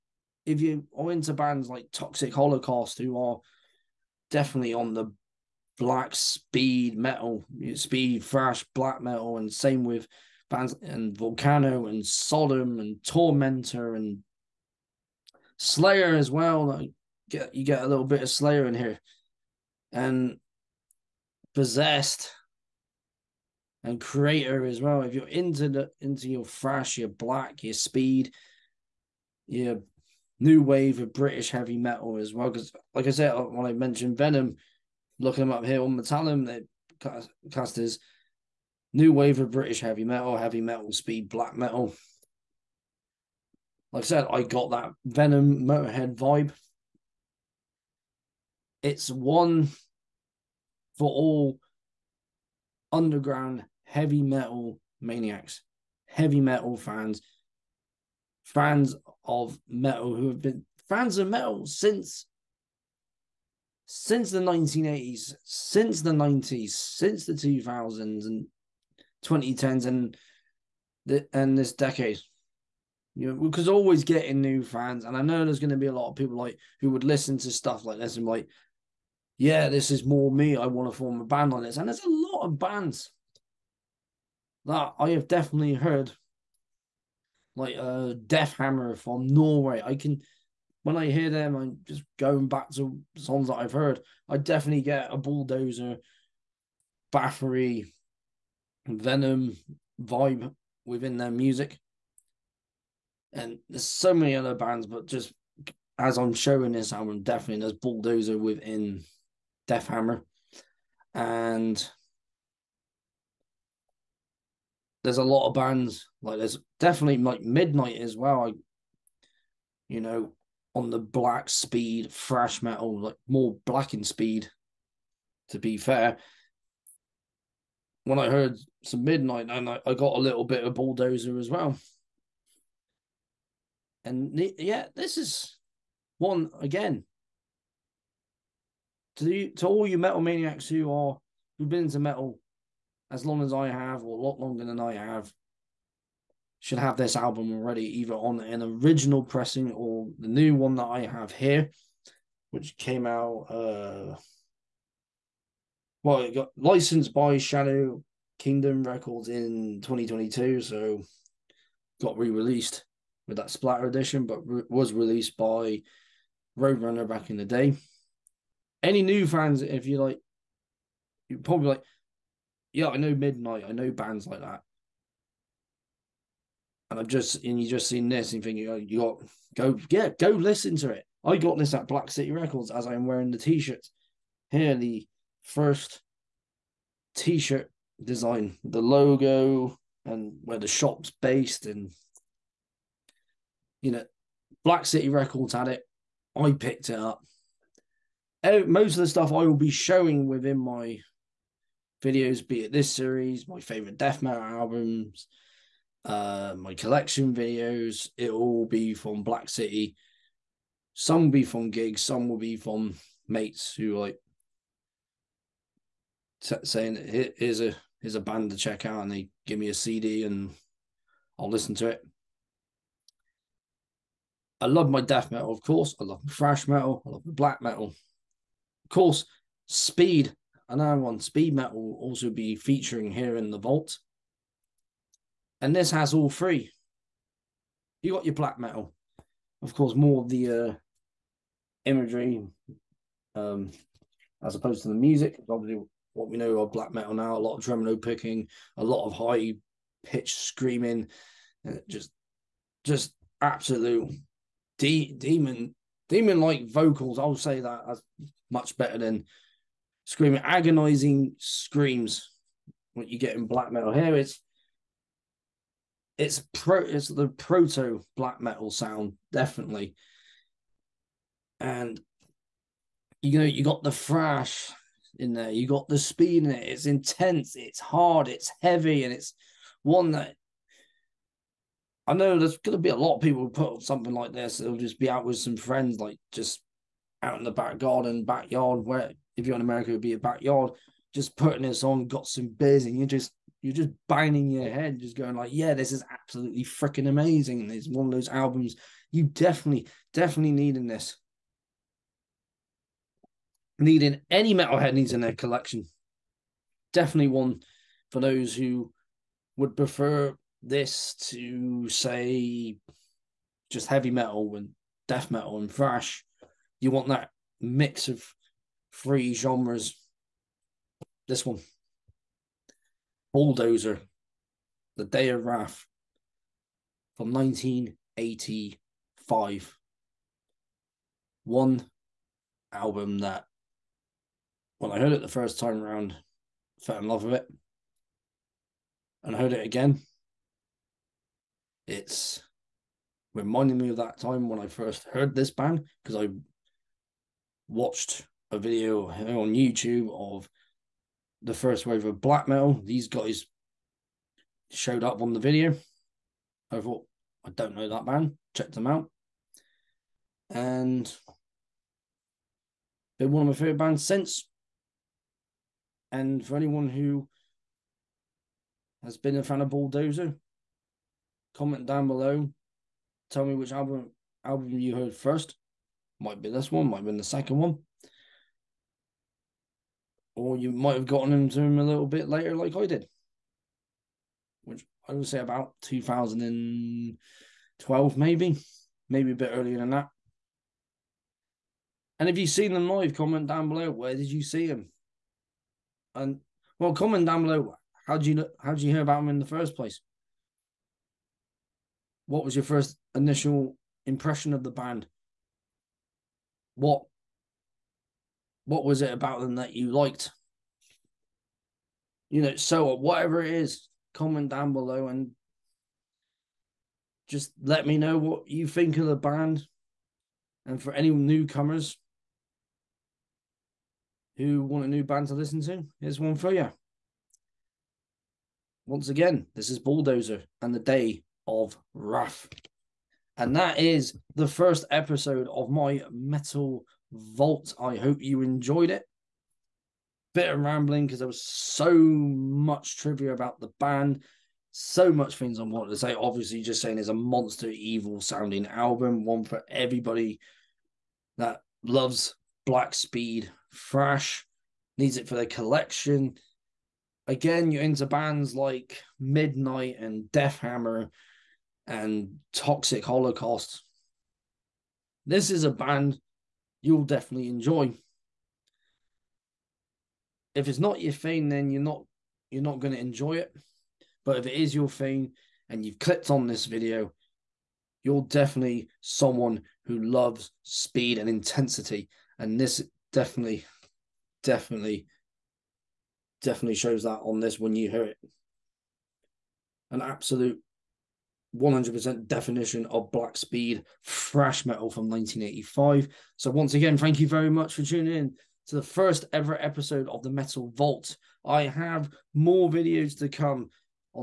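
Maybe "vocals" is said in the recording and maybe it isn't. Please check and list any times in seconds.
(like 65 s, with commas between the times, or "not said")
256 s.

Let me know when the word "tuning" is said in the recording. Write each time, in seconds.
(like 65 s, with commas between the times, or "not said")
497 s.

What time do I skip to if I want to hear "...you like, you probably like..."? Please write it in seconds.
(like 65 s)
169 s.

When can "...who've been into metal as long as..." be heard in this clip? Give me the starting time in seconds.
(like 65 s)
141 s.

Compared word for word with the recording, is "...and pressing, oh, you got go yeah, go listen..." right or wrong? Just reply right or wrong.
wrong.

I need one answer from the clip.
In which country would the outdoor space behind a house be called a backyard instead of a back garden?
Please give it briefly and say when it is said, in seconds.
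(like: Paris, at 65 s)
America, at 289 s.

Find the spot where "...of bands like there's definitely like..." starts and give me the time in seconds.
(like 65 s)
115 s.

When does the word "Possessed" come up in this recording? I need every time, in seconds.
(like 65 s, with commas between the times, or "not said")
21 s.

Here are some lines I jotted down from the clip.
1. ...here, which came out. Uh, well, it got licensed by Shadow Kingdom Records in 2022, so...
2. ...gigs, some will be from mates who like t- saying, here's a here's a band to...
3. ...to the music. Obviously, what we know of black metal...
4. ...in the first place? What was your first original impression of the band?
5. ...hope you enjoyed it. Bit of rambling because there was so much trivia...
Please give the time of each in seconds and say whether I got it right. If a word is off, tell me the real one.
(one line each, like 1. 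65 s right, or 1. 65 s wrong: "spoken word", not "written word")
1. 151 s right
2. 211 s right
3. 244 s right
4. 399 s wrong: "initial", not "original"
5. 437 s right.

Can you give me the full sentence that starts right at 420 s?
And for any newcomers who want a new band to listen to, here's one for you.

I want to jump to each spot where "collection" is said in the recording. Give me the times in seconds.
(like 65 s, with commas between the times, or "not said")
206 s, 305 s, 455 s.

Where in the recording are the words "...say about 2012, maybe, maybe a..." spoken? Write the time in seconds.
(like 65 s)
385 s.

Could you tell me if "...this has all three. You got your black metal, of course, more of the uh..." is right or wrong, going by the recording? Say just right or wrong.
right.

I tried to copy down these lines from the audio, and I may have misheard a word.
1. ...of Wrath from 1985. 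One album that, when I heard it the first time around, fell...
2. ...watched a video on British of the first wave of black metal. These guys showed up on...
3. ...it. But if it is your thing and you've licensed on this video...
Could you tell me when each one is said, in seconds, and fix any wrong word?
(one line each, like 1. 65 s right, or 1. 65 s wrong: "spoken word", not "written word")
1. 325 s right
2. 347 s wrong: "YouTube", not "British"
3. 473 s wrong: "clicked", not "licensed".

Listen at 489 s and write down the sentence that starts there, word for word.
An absolute 100% definition of Black Speed, thrash metal from 1985.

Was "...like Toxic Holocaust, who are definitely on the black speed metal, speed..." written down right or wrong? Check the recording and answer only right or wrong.
right.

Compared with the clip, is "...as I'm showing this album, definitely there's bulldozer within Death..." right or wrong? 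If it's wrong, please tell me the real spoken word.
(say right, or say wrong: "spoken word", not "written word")
right.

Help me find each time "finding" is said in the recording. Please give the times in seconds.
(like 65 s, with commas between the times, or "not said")
not said.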